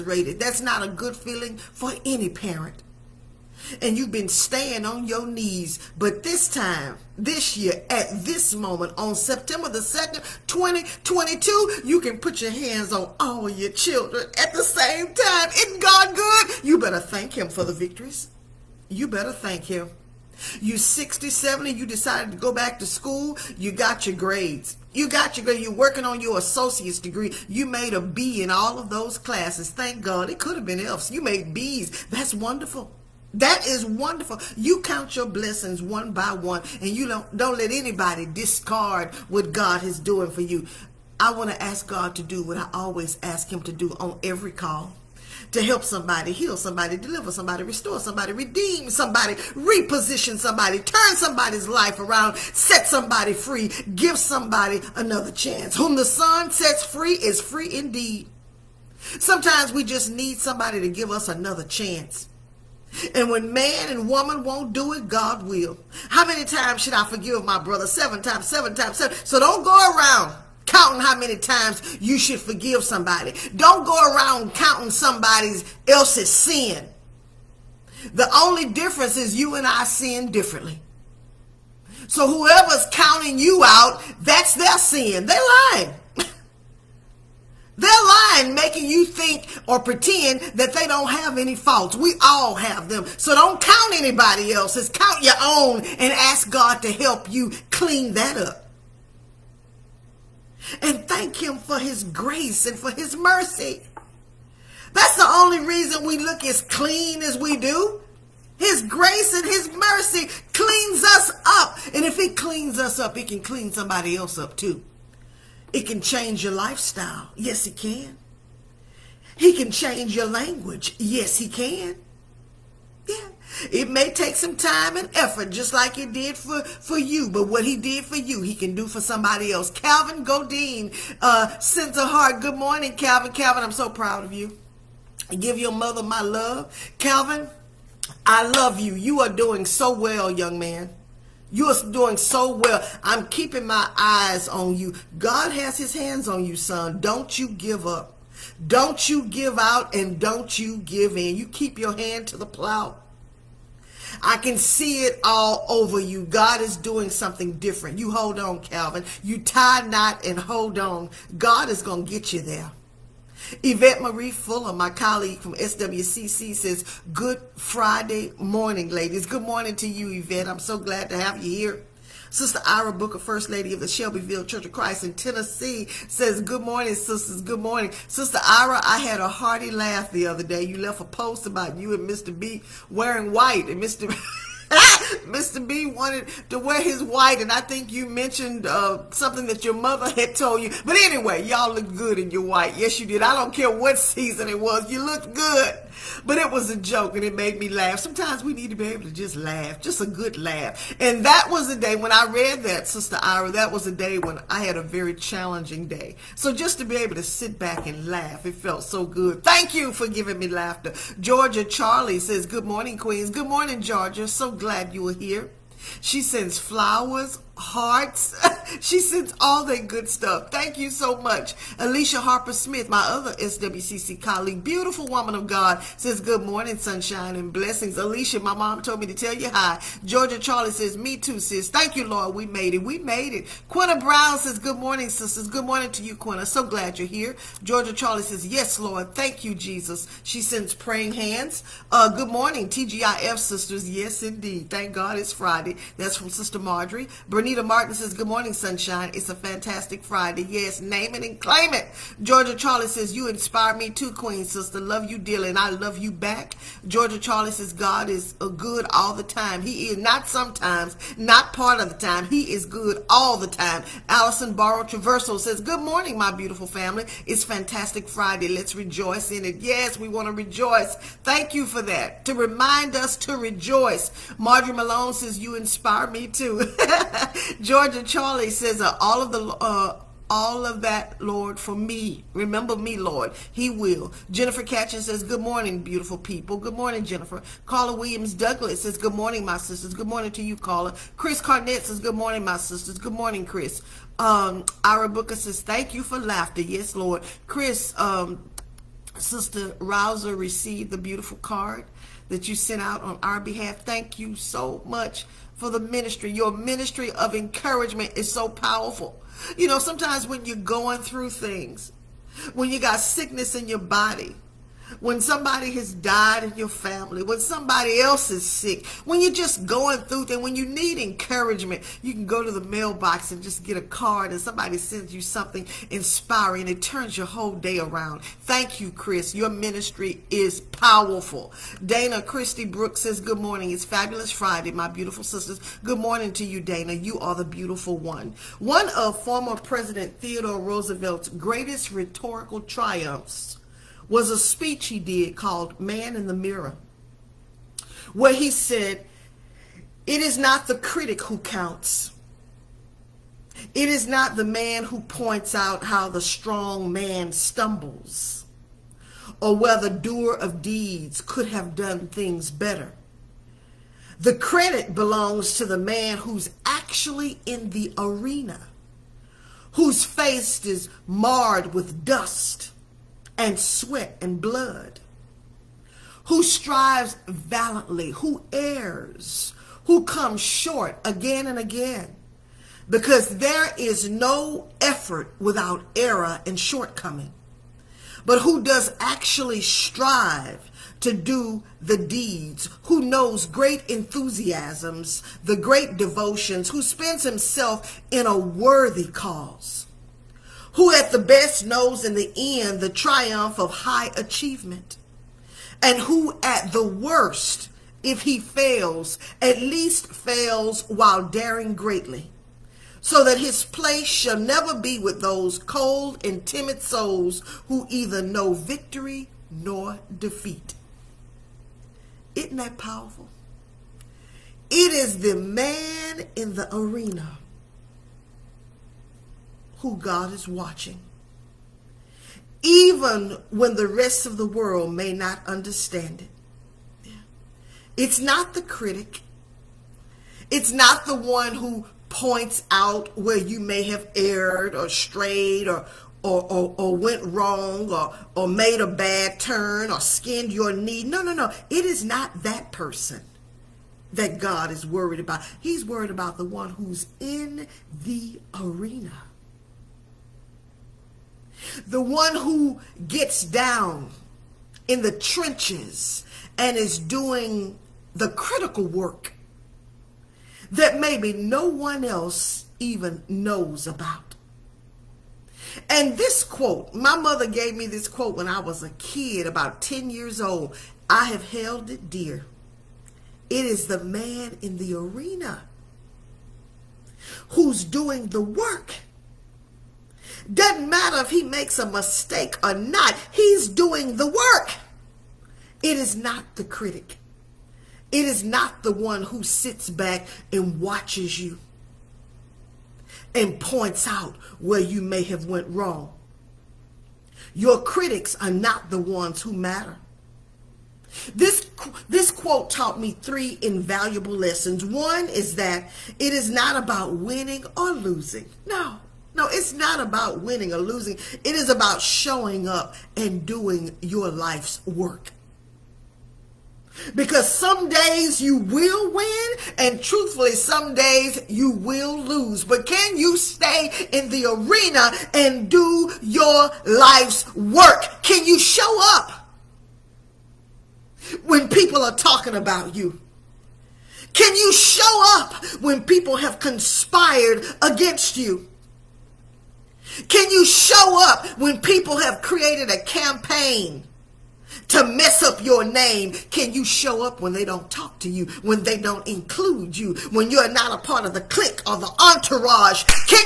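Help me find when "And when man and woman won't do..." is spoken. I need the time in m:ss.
1:03.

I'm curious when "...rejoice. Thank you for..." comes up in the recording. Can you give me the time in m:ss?
4:30.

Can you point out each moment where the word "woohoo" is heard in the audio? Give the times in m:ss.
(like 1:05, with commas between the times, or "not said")
not said.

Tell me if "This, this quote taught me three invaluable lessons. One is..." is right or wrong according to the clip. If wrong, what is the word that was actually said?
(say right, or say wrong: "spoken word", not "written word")
right.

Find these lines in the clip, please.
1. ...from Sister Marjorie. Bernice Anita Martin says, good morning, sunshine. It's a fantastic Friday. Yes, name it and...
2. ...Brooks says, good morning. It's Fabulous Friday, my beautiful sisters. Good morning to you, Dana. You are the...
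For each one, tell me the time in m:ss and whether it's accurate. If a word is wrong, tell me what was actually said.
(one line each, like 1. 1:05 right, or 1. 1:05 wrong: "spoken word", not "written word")
1. 4:06 right
2. 5:32 right.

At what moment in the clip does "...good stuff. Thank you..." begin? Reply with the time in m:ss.
3:39.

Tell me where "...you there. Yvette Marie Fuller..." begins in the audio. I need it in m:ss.
2:42.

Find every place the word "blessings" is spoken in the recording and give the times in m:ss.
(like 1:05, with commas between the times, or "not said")
0:35, 3:47.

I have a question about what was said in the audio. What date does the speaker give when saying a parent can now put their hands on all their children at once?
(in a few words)
September 2, 2022.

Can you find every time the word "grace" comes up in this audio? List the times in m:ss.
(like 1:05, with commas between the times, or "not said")
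1:42, 1:48.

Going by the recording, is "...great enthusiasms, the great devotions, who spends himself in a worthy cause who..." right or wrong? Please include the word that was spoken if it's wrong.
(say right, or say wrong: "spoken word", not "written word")
right.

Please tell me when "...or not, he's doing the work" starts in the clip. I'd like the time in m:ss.
8:12.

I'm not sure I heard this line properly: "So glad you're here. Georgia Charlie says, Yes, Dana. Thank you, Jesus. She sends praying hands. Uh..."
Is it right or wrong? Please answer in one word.
wrong.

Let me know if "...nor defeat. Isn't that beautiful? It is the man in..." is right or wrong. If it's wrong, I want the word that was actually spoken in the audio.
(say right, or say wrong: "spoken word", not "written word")
wrong: "powerful", not "beautiful".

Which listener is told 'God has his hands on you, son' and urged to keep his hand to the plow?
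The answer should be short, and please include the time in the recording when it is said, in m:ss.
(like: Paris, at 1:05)
Calvin Godine, at 2:09.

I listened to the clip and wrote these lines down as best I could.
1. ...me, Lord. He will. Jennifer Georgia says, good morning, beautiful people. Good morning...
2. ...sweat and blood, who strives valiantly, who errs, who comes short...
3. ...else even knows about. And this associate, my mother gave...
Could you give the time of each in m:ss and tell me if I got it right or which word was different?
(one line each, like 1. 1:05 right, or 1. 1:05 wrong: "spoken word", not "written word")
1. 4:42 wrong: "Catchin", not "Georgia"
2. 6:13 right
3. 7:52 wrong: "quote", not "associate".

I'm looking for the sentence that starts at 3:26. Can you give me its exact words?
So just to be able to sit back and laugh, it felt so good.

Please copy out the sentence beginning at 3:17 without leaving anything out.
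Sometimes we need to be able to just laugh, just a good laugh.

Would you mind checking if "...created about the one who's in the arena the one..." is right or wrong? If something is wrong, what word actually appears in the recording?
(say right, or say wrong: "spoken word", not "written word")
wrong: "worried", not "created".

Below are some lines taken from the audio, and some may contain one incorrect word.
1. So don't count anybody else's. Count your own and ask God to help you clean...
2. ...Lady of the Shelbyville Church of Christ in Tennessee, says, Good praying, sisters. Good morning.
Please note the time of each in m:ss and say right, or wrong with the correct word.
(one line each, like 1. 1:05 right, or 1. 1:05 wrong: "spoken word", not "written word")
1. 1:33 right
2. 2:53 wrong: "morning", not "praying".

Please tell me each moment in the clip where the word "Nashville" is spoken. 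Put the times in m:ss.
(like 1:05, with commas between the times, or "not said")
not said.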